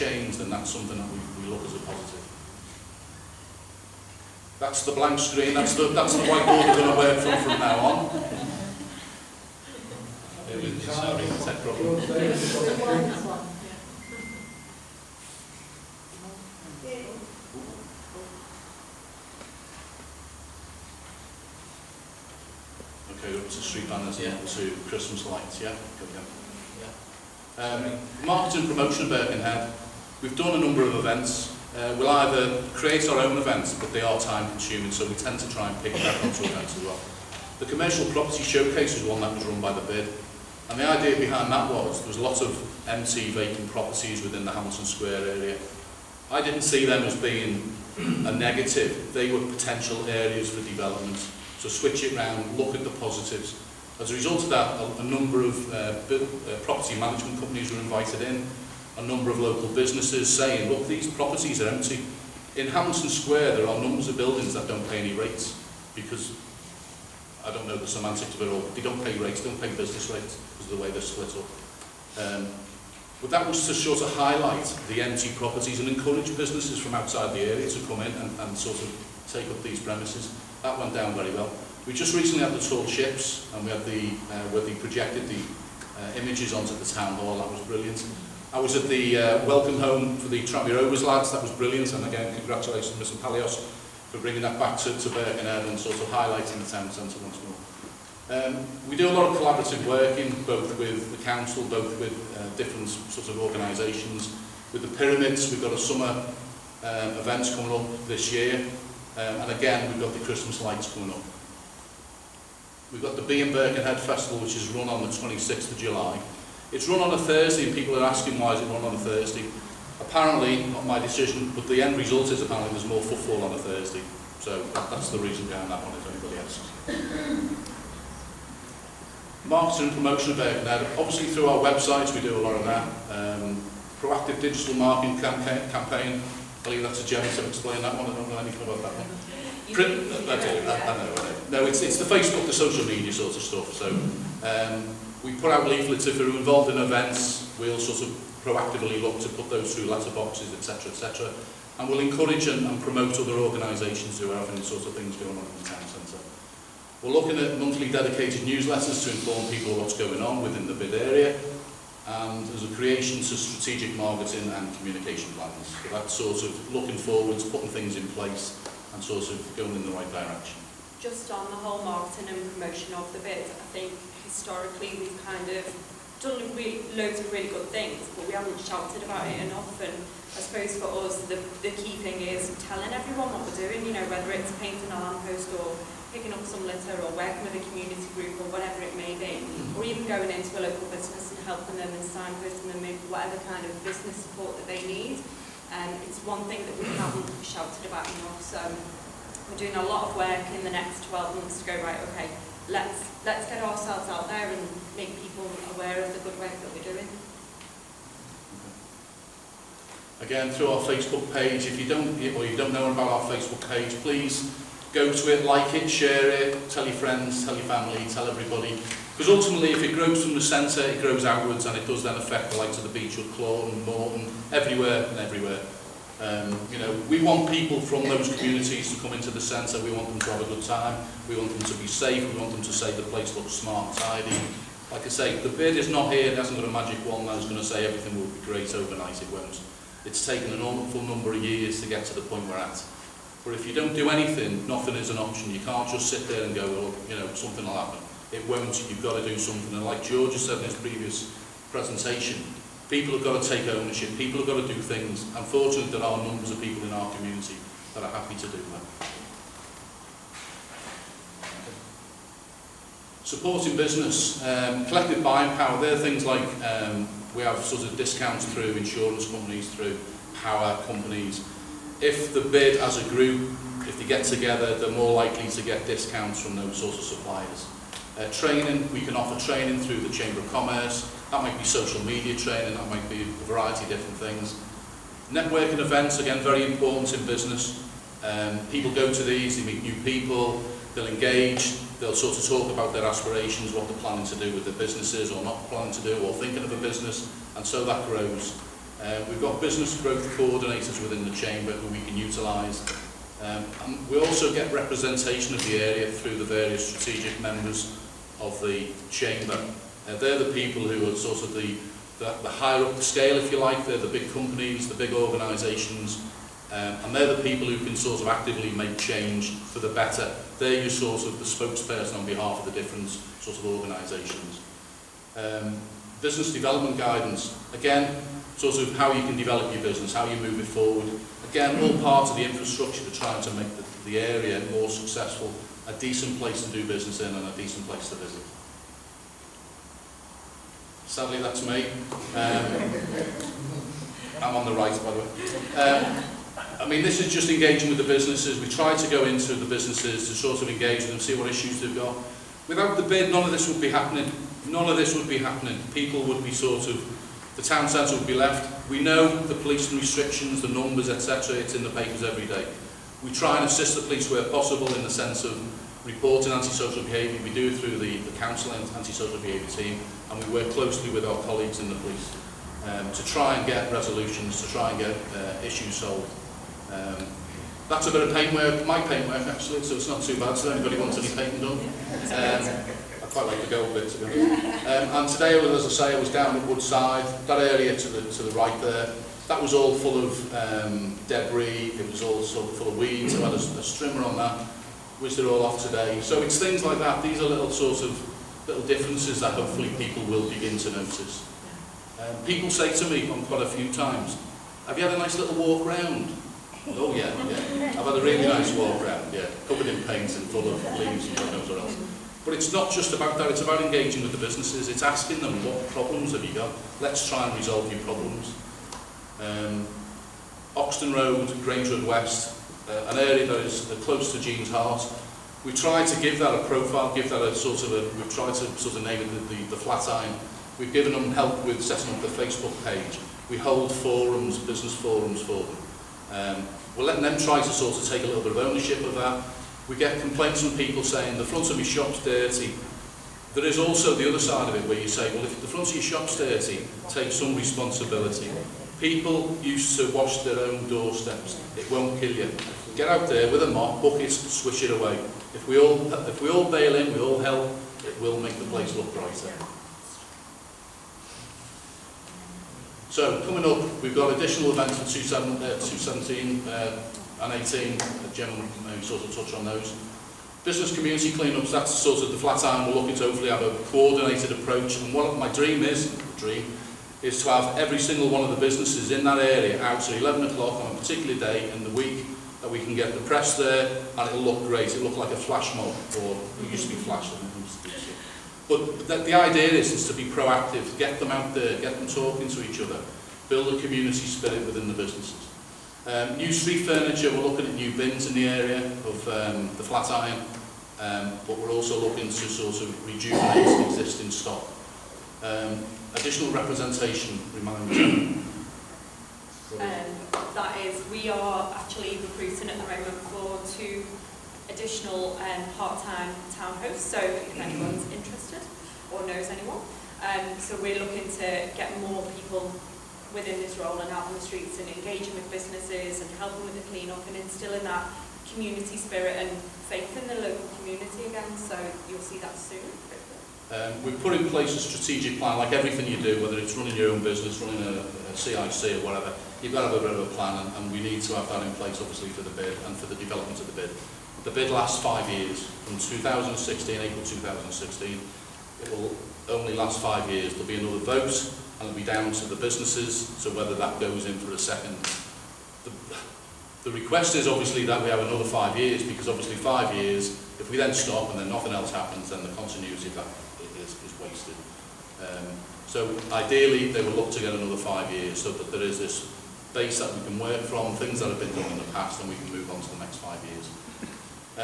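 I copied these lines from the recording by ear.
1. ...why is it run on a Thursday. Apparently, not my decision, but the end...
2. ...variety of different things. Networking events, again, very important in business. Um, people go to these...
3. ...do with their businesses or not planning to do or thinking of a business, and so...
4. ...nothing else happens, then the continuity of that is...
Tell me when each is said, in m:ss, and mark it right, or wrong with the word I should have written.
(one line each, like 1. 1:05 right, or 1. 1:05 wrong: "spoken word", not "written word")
1. 1:58 right
2. 4:43 right
3. 4:54 right
4. 9:21 right.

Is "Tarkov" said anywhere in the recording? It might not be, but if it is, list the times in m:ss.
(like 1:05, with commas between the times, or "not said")
not said.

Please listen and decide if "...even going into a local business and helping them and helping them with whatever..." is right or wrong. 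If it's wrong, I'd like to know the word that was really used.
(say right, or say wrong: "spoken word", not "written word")
wrong: "signposting", not "helping".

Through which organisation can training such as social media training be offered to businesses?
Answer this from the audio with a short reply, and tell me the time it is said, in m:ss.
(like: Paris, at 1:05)
Chamber of Commerce, at 4:40.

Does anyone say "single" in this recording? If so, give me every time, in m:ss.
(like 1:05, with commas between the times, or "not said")
7:57.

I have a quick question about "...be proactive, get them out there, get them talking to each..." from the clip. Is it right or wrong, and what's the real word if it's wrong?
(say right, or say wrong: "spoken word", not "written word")
right.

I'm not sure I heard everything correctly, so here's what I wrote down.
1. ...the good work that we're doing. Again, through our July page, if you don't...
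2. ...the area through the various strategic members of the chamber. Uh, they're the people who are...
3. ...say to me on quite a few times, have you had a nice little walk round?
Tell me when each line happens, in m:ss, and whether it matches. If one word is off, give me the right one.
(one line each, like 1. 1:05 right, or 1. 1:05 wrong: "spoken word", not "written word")
1. 3:26 wrong: "Facebook", not "July"
2. 5:05 right
3. 6:42 right.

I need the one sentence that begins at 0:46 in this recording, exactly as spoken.
I didn't see them as being a negative.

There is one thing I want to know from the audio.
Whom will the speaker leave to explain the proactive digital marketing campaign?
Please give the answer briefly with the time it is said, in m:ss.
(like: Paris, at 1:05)
Jenny, at 2:17.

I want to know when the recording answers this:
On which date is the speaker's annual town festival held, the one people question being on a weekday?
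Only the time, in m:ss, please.
1:55.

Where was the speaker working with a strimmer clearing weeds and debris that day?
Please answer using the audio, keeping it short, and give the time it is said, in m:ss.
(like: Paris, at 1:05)
Woodside, at 6:26.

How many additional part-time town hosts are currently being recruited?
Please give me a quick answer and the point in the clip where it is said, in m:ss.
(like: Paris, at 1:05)
2, at 8:33.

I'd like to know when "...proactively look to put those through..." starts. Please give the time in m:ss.
2:28.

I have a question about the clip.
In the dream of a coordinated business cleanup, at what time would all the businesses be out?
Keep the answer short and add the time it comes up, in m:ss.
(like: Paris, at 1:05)
11 o'clock, at 8:00.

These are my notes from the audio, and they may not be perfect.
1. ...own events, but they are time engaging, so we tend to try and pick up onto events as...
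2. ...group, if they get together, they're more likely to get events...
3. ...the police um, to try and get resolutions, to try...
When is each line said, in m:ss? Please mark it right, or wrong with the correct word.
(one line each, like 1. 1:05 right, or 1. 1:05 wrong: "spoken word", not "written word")
1. 0:33 wrong: "consuming", not "engaging"
2. 4:33 wrong: "discounts", not "events"
3. 6:11 right.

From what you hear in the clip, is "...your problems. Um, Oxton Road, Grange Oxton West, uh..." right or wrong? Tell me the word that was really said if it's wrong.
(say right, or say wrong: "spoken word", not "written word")
wrong: "Road", not "Oxton".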